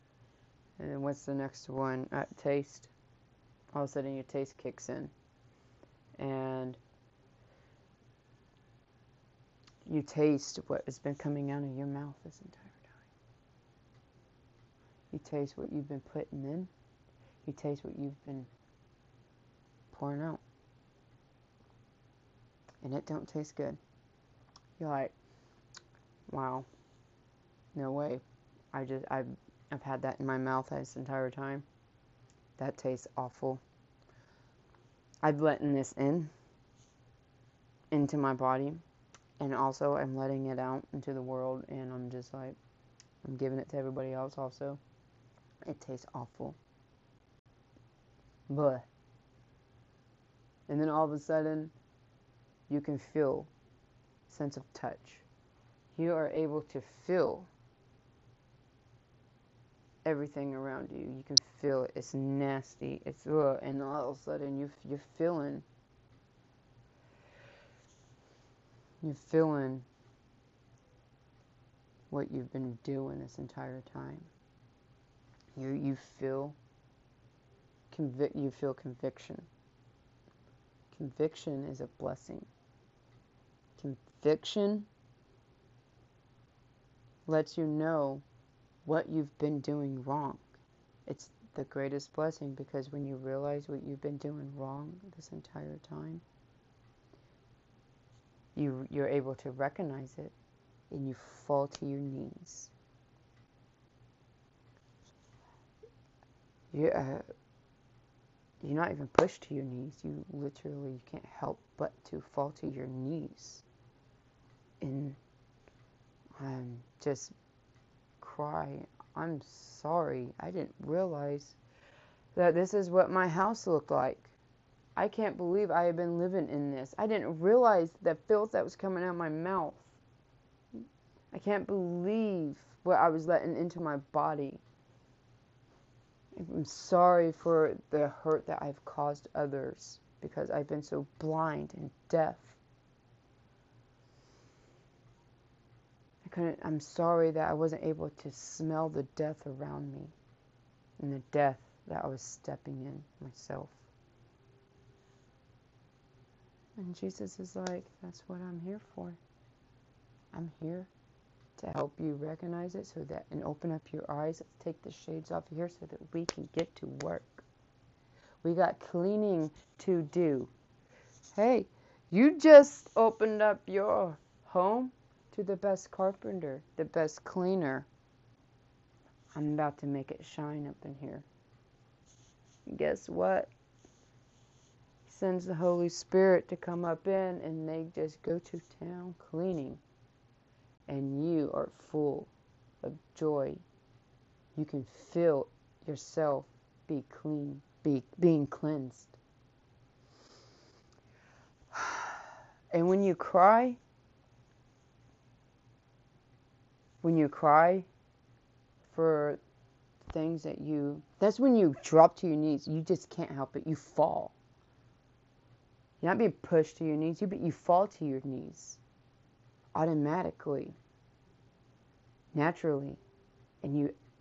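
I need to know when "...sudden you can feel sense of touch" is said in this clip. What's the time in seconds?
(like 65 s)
51 s.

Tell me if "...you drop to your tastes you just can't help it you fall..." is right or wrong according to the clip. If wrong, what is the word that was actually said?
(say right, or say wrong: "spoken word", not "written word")
wrong: "knees", not "tastes".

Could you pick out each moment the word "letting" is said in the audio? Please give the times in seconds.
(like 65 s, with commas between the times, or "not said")
35 s, 40 s, 133 s.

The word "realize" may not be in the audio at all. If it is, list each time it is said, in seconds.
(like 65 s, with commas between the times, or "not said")
93 s, 120 s, 127 s.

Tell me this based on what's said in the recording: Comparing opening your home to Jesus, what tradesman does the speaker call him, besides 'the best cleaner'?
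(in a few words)
Carpenter.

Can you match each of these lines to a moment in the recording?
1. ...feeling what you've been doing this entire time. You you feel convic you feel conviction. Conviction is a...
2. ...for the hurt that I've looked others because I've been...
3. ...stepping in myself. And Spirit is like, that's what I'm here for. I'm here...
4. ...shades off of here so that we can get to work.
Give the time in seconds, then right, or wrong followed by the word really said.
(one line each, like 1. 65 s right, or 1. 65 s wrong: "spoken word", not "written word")
1. 69 s right
2. 137 s wrong: "caused", not "looked"
3. 152 s wrong: "Jesus", not "Spirit"
4. 164 s right.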